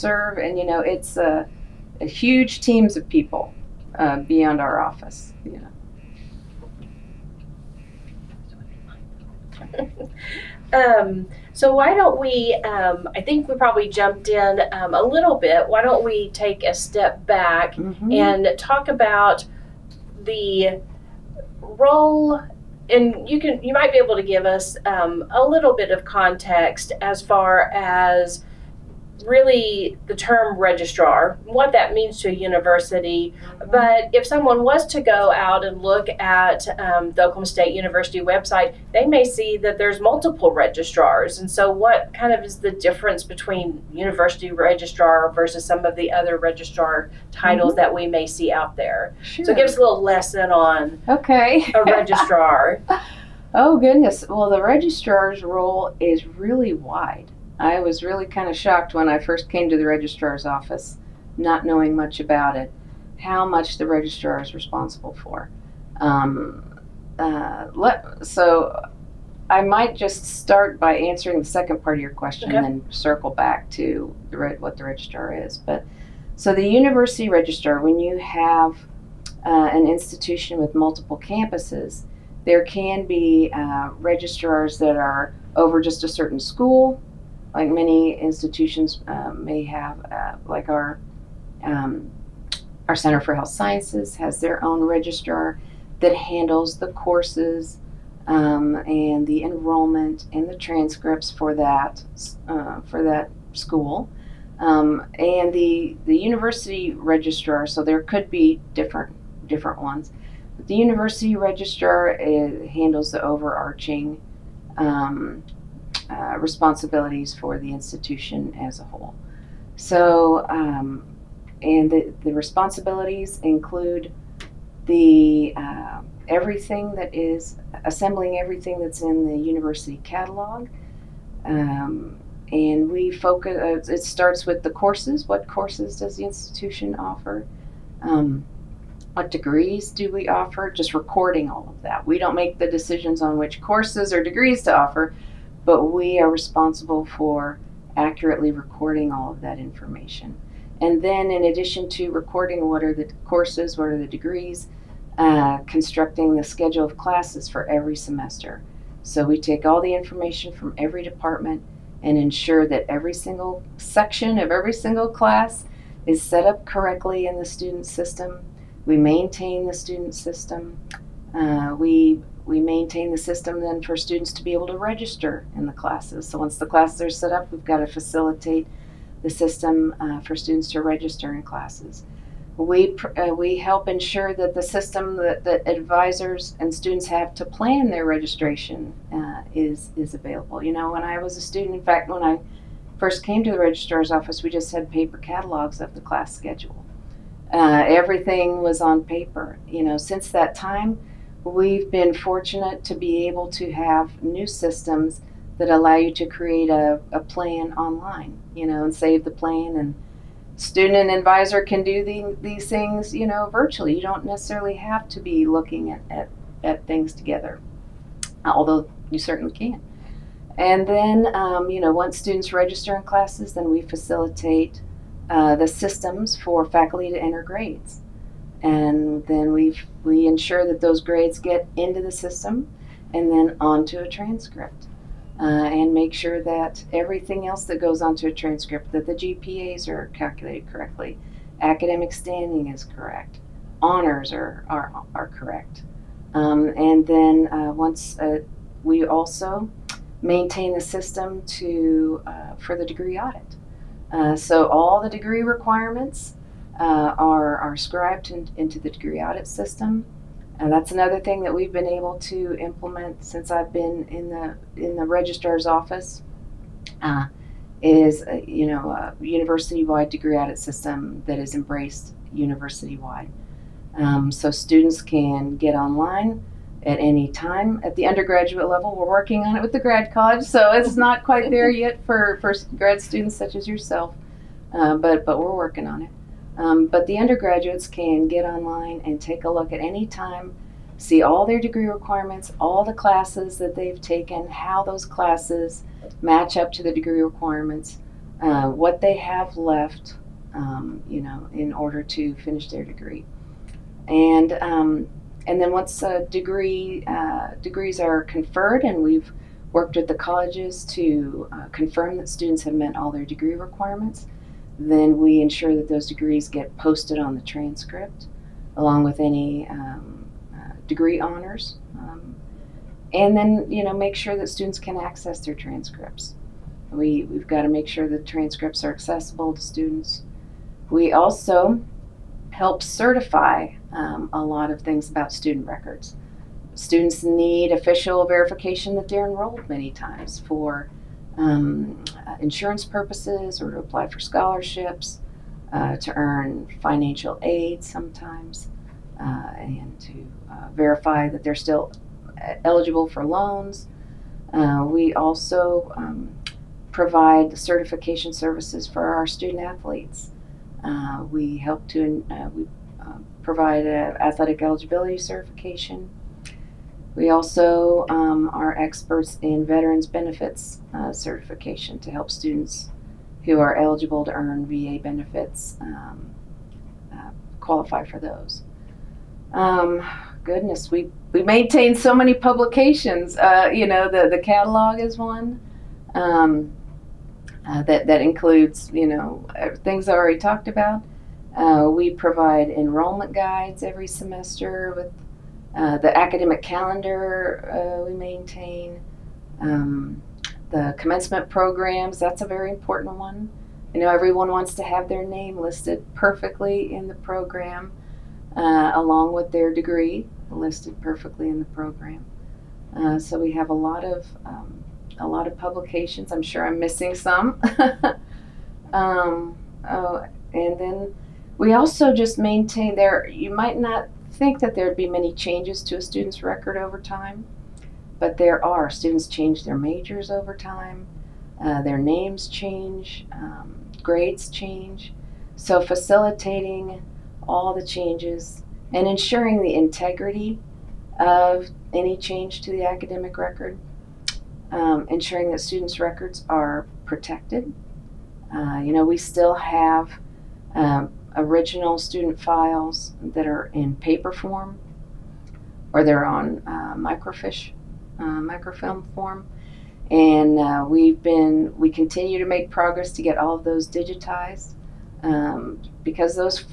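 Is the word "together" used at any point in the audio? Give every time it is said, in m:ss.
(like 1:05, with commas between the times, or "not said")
3:37.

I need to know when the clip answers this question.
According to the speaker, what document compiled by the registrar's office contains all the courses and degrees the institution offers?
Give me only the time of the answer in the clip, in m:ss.
2:09.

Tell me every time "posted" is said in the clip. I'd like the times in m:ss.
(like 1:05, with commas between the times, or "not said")
5:16.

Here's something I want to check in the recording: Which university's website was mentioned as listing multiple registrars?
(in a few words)
Oklahoma State University.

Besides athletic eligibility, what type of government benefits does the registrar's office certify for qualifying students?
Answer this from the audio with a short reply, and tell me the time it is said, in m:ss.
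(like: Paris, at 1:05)
VA benefits, at 6:14.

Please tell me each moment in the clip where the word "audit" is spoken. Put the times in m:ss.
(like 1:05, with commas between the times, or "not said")
4:13, 4:19, 4:30.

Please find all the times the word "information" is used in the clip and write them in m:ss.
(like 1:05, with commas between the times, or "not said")
2:29, 2:39.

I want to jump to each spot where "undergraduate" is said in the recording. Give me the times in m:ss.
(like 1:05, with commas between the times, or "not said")
4:38, 4:47.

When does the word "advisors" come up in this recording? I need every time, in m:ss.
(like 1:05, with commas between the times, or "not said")
3:05, 3:31.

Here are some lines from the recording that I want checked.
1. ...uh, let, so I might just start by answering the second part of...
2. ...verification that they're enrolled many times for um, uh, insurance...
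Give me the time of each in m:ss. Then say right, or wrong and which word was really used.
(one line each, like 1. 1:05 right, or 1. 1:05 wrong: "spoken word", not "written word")
1. 1:07 right
2. 5:38 right.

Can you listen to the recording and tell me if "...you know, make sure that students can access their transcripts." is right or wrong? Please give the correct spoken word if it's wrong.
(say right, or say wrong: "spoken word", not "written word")
right.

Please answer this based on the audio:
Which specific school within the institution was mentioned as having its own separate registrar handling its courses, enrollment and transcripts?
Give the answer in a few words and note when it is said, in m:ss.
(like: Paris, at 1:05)
Center for Health Sciences, at 1:32.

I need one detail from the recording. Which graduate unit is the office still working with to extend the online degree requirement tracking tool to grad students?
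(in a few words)
the grad college.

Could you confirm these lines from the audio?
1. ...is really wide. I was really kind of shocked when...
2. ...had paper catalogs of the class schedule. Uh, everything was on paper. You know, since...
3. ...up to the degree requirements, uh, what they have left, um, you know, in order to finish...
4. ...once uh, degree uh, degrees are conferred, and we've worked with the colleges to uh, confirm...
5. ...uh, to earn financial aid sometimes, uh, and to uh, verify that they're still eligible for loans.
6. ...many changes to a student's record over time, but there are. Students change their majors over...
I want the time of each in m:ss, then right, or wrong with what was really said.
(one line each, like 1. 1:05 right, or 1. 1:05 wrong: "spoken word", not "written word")
1. 0:55 right
2. 3:14 right
3. 4:56 right
4. 5:05 right
5. 5:45 right
6. 7:05 right.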